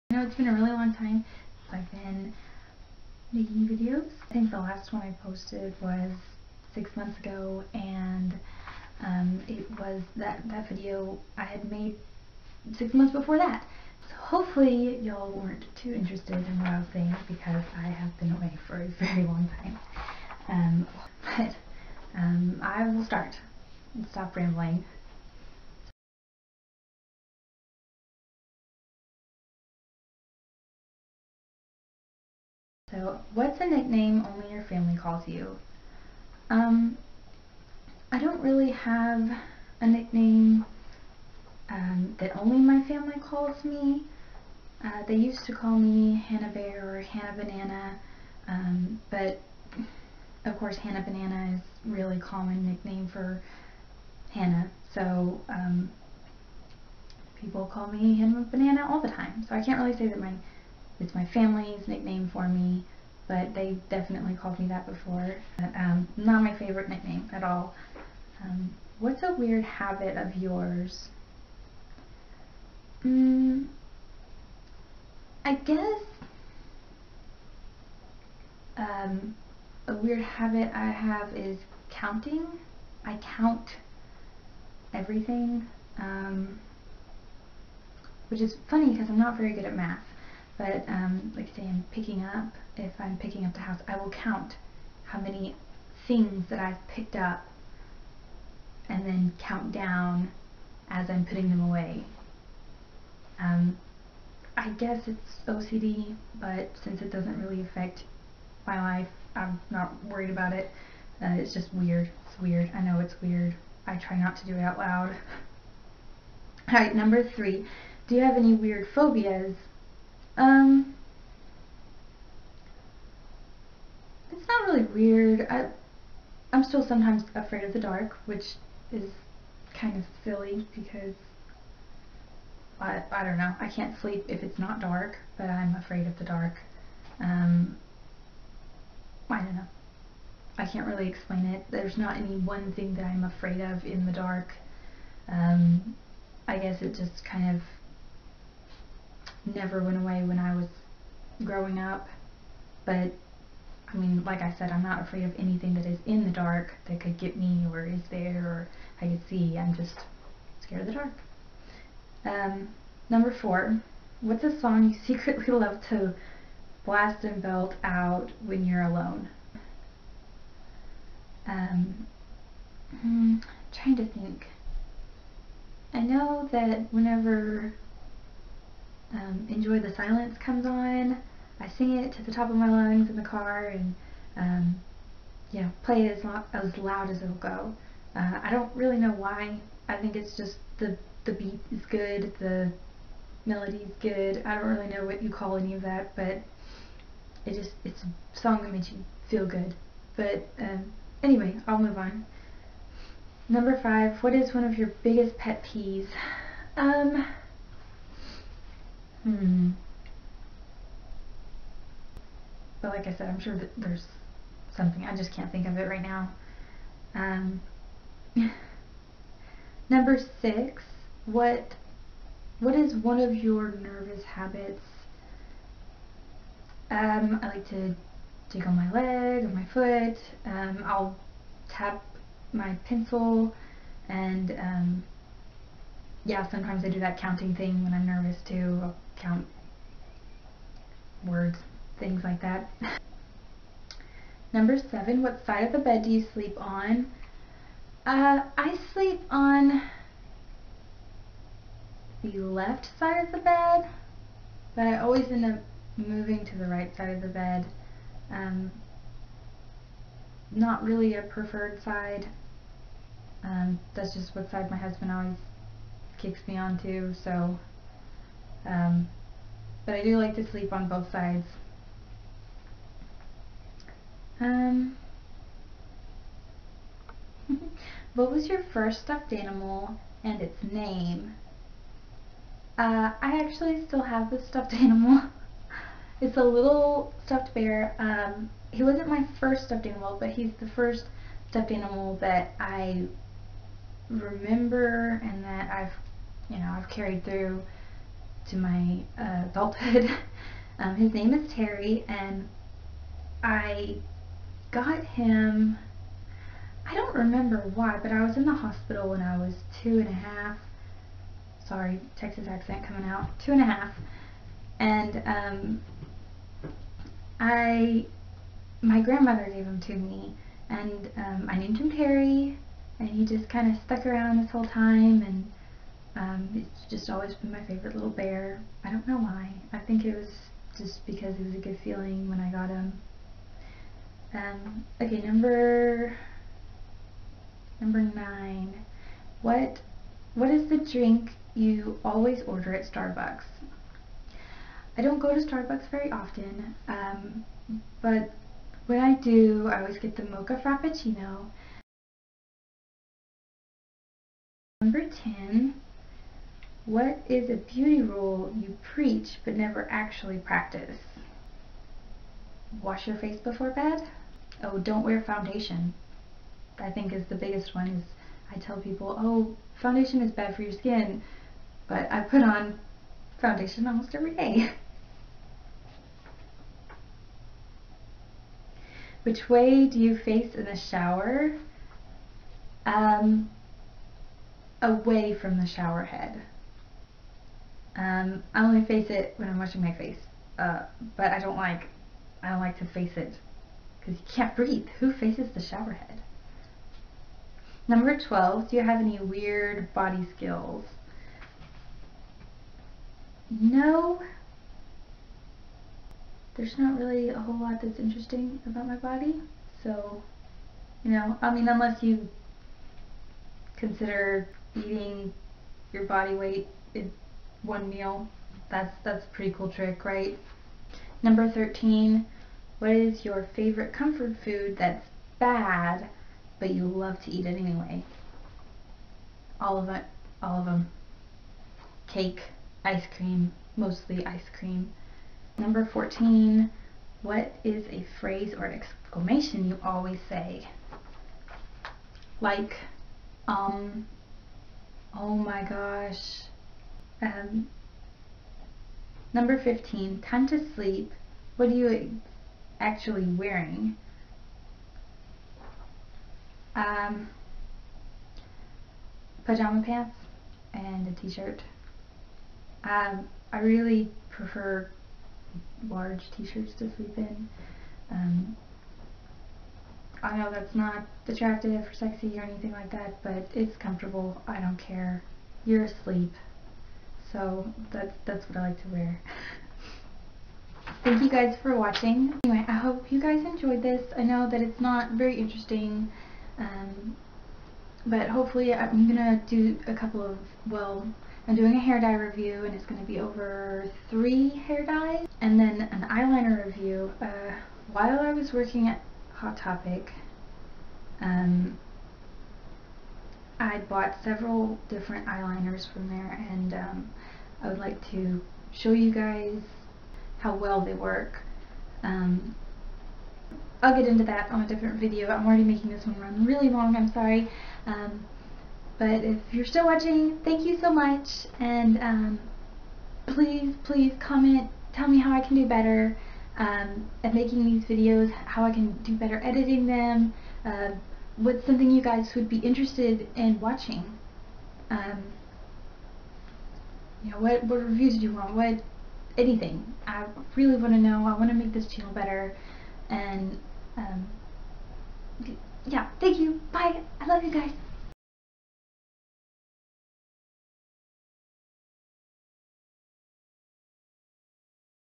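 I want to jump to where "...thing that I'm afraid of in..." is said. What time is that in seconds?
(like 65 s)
142 s.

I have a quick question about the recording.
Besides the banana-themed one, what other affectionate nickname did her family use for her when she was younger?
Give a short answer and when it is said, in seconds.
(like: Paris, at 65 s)
Hannah Bear, at 46 s.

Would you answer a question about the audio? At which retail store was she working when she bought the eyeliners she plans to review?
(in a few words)
Hot Topic.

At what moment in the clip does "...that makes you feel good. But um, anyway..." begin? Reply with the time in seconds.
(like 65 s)
198 s.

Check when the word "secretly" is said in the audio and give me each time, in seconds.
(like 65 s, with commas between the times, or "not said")
165 s.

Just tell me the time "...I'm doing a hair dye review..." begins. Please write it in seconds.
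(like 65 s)
491 s.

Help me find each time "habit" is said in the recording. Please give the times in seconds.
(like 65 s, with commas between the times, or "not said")
69 s, 80 s, 224 s.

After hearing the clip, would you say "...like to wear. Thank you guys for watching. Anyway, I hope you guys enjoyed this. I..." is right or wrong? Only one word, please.
right.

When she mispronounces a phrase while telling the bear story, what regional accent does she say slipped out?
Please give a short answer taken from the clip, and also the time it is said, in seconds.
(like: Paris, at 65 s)
Texas, at 312 s.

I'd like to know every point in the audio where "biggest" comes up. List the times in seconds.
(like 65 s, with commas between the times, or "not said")
205 s, 367 s.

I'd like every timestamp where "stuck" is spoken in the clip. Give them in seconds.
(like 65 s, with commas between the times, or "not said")
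323 s.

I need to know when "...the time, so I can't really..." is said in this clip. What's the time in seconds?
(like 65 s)
58 s.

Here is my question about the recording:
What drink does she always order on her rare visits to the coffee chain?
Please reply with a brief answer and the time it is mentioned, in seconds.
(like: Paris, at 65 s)
Mocha frappuccino, at 350 s.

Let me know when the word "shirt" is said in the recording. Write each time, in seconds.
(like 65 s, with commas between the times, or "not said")
461 s, 466 s.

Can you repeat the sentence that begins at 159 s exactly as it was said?
I'm just scared of the dark.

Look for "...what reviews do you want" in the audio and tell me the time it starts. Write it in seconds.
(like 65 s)
537 s.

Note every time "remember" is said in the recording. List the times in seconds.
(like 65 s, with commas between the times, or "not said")
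294 s, 307 s.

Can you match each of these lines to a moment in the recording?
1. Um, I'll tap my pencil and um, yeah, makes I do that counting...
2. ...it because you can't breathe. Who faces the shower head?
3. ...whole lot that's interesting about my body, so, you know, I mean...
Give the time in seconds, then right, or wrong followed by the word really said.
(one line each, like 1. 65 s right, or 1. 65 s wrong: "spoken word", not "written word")
1. 230 s wrong: "sometimes", not "makes"
2. 393 s right
3. 407 s right.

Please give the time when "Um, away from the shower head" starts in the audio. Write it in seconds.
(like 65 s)
382 s.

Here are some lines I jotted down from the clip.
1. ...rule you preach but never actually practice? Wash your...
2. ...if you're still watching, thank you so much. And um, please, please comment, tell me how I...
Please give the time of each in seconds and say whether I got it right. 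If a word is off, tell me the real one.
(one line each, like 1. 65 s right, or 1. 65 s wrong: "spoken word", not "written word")
1. 358 s right
2. 519 s right.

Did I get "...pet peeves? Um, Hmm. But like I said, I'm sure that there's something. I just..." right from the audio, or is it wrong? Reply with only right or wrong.
right.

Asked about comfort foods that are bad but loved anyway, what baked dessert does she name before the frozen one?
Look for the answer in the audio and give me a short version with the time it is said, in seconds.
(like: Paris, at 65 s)
Cake, at 432 s.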